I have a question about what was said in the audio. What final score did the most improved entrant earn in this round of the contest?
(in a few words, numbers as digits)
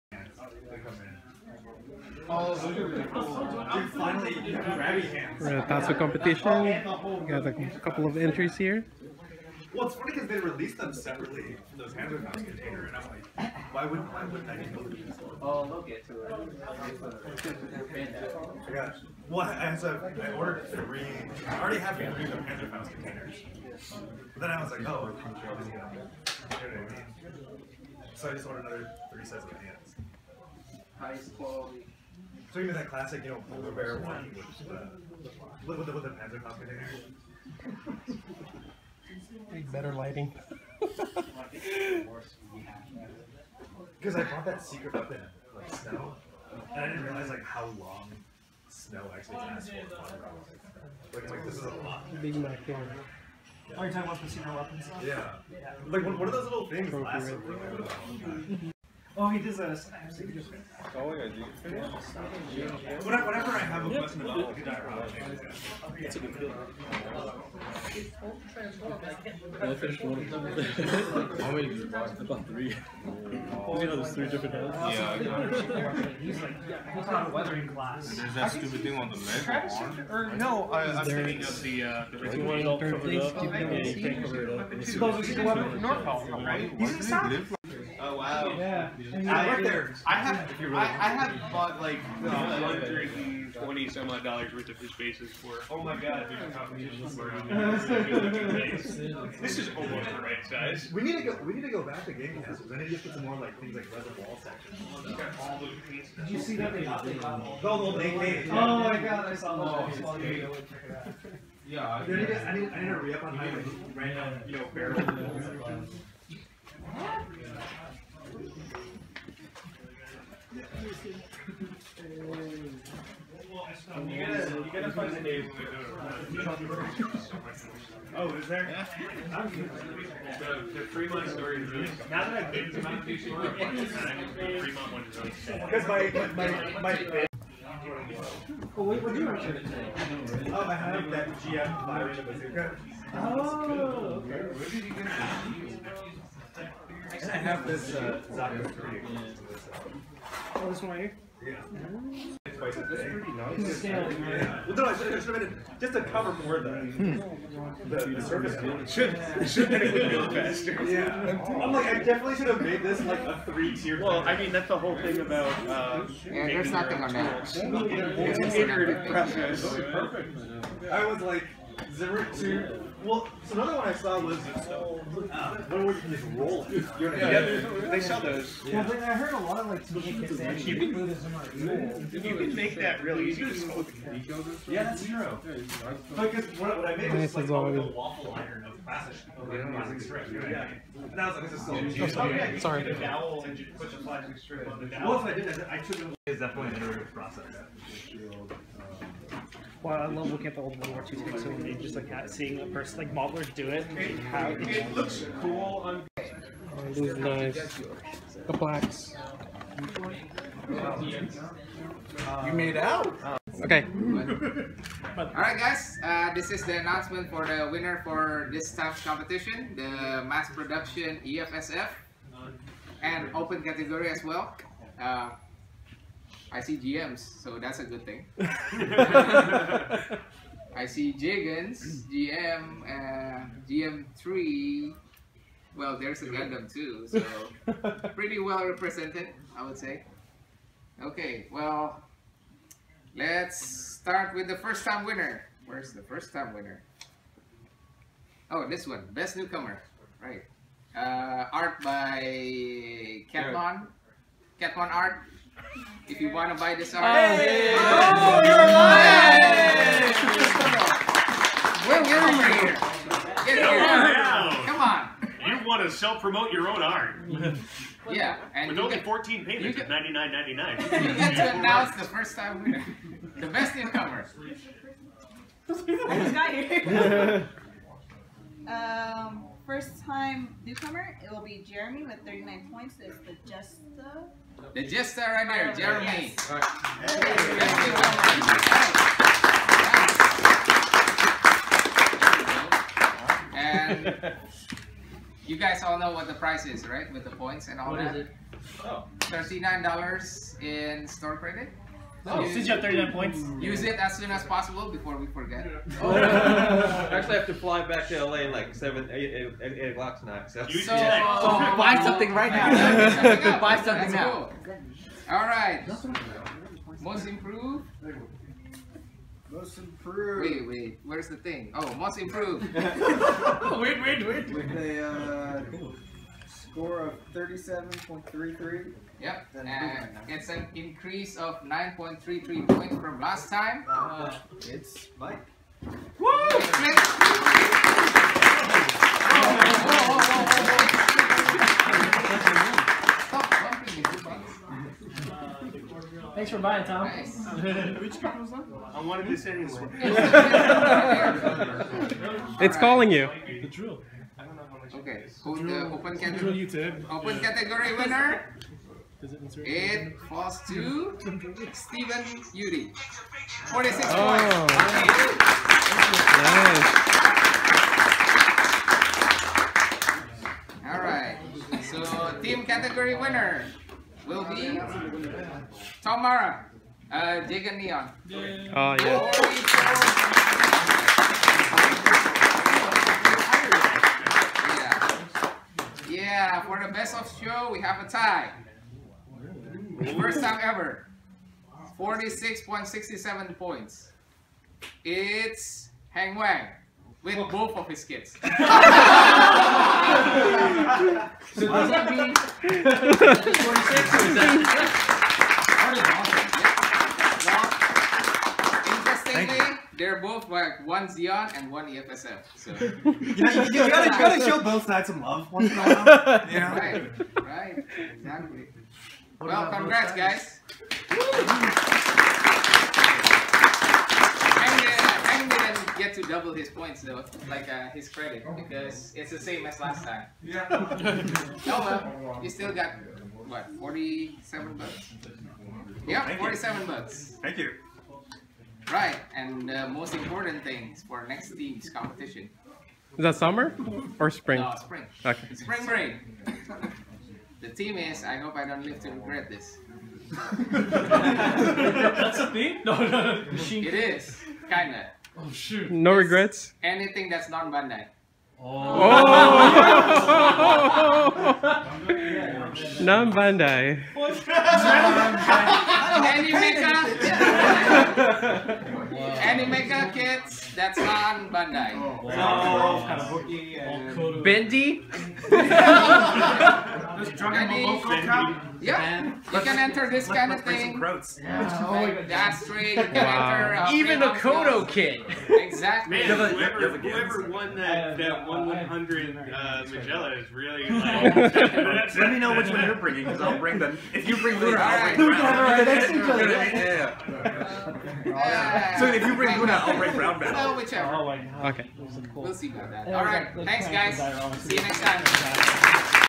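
37.33.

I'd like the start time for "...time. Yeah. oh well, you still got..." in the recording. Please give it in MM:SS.
07:10.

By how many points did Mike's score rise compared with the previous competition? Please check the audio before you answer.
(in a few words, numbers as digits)
9.33.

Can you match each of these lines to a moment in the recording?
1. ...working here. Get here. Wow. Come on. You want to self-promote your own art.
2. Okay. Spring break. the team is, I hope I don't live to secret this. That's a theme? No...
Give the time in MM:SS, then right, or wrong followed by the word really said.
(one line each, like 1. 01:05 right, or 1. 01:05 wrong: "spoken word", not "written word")
1. 04:22 right
2. 07:25 wrong: "regret", not "secret".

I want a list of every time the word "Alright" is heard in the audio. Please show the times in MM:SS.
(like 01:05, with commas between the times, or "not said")
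03:35, 06:10.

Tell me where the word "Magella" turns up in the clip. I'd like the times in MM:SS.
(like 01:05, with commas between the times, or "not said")
08:09.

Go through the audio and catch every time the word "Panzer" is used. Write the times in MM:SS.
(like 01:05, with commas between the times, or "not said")
00:36.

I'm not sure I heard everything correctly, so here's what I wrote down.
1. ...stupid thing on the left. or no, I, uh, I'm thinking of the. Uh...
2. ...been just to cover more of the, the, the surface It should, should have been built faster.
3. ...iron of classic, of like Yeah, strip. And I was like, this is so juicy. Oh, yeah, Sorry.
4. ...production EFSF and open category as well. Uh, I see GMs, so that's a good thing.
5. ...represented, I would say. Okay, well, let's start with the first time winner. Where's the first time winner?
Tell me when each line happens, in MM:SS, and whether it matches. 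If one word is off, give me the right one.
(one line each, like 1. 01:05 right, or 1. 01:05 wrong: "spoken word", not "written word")
1. 01:18 right
2. 02:35 right
3. 03:08 right
4. 03:40 right
5. 03:58 right.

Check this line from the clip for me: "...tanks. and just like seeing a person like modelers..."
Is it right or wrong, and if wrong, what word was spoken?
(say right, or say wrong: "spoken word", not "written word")
right.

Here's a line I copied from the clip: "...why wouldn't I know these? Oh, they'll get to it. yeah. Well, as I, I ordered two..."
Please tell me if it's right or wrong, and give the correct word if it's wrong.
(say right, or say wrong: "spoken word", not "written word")
wrong: "three", not "two".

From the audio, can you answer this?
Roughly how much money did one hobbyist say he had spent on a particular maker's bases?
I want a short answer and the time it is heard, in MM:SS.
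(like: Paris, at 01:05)
$120, at 01:32.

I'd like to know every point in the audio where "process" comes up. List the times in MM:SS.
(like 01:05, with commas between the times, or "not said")
02:49, 03:17.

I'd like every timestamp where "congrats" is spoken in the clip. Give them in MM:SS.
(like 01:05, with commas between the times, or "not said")
06:59.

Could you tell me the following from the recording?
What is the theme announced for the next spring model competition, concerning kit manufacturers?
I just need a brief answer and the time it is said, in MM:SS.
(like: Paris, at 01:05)
Anything that's not Bandai, at 07:36.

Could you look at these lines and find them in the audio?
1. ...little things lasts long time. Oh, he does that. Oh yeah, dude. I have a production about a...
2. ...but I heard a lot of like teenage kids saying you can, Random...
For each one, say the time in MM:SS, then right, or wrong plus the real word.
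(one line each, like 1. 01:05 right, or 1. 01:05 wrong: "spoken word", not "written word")
1. 00:56 wrong: "question", not "production"
2. 02:58 wrong: "Buddhism", not "Random".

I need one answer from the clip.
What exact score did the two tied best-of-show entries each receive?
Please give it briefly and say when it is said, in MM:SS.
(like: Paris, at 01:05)
46.67, at 06:31.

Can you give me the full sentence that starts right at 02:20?
Oh, I have that GM Byron Bazooka.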